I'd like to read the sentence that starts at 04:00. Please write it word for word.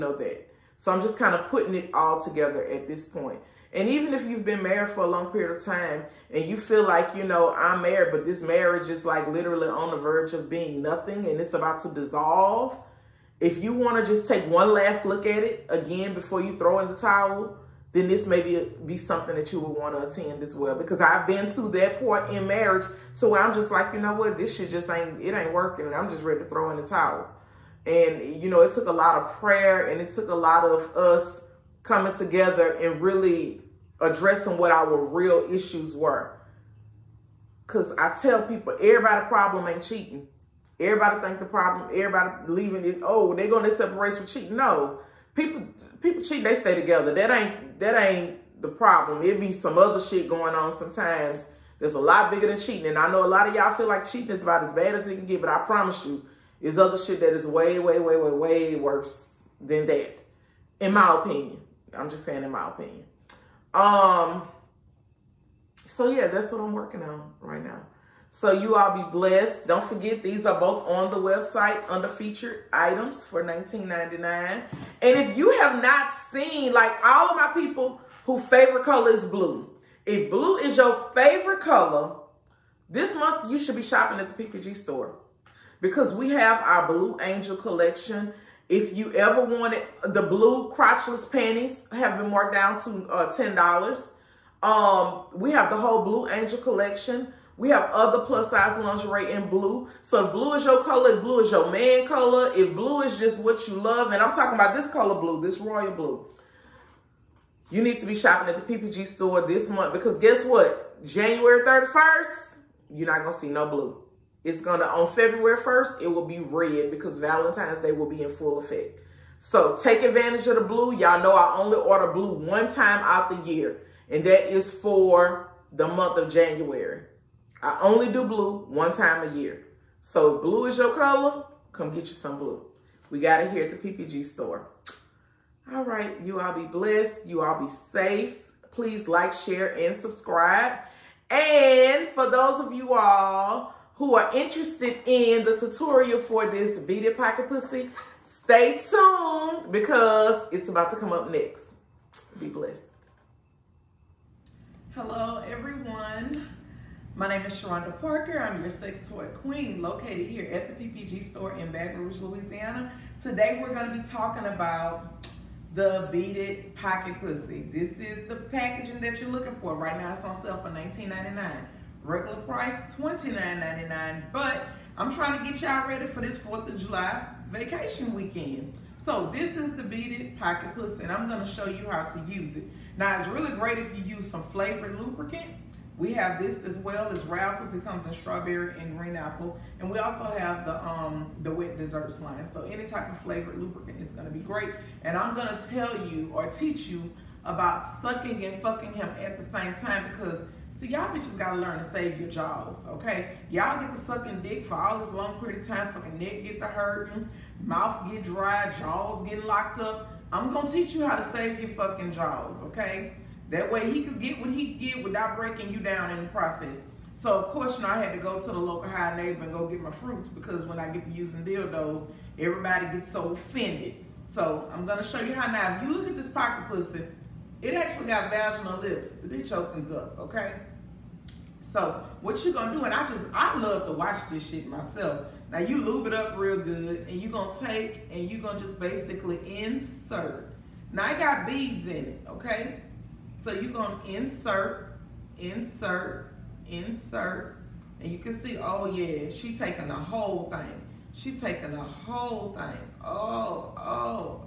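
Now I got beads in it, okay?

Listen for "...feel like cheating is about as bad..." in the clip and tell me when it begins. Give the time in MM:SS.
00:53.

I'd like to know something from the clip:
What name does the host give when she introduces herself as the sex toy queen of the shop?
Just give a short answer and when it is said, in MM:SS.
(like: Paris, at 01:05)
Sharonda Parker, at 02:37.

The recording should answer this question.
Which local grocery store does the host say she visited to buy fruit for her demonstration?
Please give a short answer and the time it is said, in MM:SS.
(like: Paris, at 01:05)
Hi Nabor, at 03:38.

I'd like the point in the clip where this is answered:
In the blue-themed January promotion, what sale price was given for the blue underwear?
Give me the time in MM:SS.
01:33.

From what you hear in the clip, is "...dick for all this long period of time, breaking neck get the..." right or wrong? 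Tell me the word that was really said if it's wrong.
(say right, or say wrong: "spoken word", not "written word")
wrong: "fucking", not "breaking".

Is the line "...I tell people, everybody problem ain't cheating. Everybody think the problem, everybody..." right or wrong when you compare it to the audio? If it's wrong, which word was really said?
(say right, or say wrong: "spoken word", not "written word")
right.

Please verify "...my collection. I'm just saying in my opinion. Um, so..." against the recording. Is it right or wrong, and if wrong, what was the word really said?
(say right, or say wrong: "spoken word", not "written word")
wrong: "opinion", not "collection".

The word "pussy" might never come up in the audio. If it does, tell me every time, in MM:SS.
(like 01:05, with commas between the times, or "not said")
02:27, 02:47, 03:00, 03:46.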